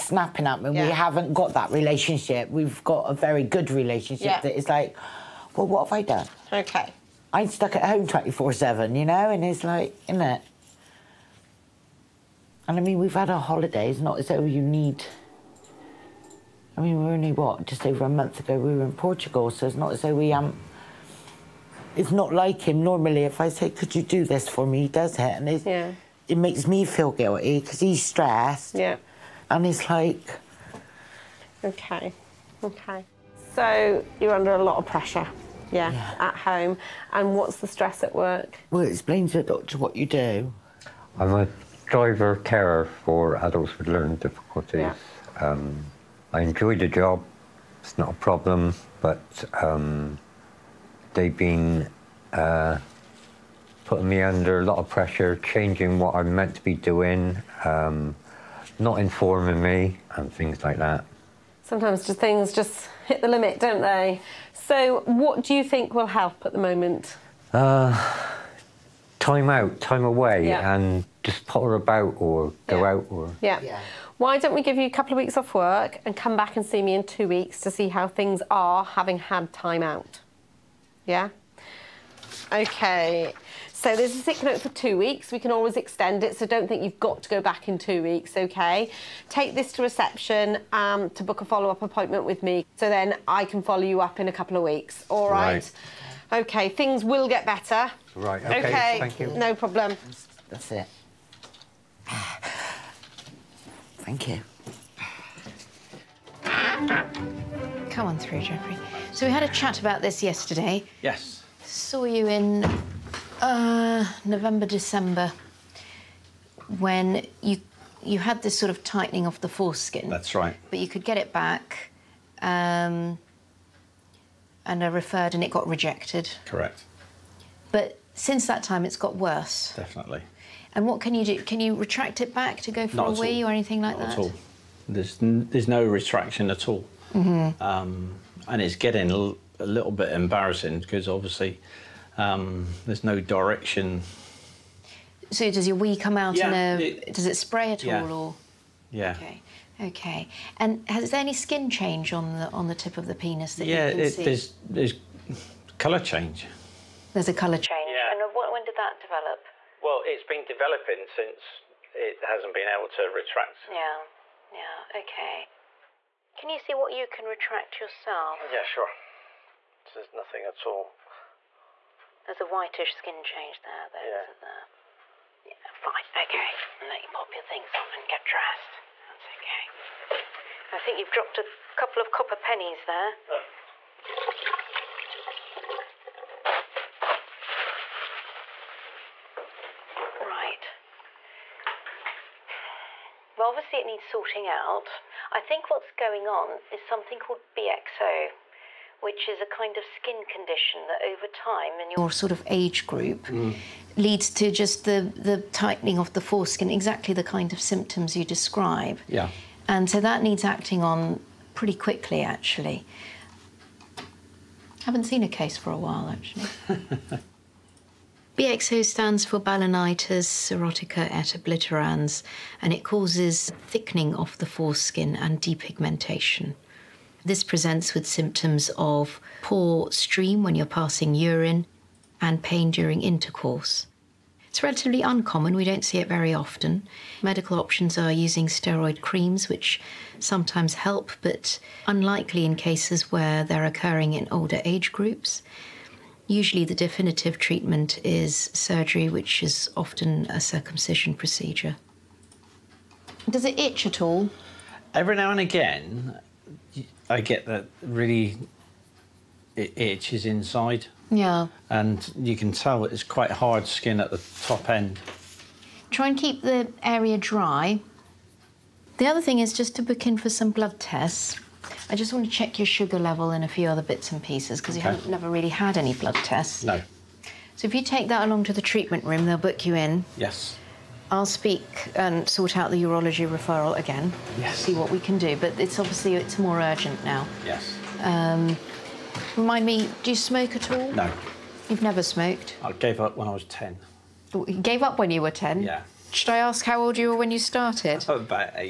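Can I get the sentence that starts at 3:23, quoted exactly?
leads to just the, the tightening of the foreskin, exactly the kind of symptoms you describe.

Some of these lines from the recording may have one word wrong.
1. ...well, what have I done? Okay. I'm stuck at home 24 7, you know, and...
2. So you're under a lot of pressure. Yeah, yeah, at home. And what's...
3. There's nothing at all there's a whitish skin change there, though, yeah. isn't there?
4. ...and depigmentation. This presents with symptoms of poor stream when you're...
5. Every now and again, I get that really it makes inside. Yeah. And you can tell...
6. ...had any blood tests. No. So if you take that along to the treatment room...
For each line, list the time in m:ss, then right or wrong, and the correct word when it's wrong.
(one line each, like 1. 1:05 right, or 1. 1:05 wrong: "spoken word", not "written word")
1. 0:05 right
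2. 0:33 right
3. 2:49 right
4. 3:45 right
5. 4:14 wrong: "itches", not "makes"
6. 4:35 right.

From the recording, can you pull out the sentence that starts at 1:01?
Sometimes just things just hit the limit, don't they?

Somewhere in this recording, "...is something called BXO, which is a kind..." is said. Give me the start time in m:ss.
3:16.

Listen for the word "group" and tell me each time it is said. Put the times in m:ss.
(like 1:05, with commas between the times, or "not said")
3:22, 4:04.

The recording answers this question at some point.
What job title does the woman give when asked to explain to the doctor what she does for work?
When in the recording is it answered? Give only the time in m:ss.
0:41.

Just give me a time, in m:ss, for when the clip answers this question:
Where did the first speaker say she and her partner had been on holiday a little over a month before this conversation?
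0:18.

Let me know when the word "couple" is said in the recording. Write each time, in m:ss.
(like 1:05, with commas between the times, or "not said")
1:14, 1:34, 3:01.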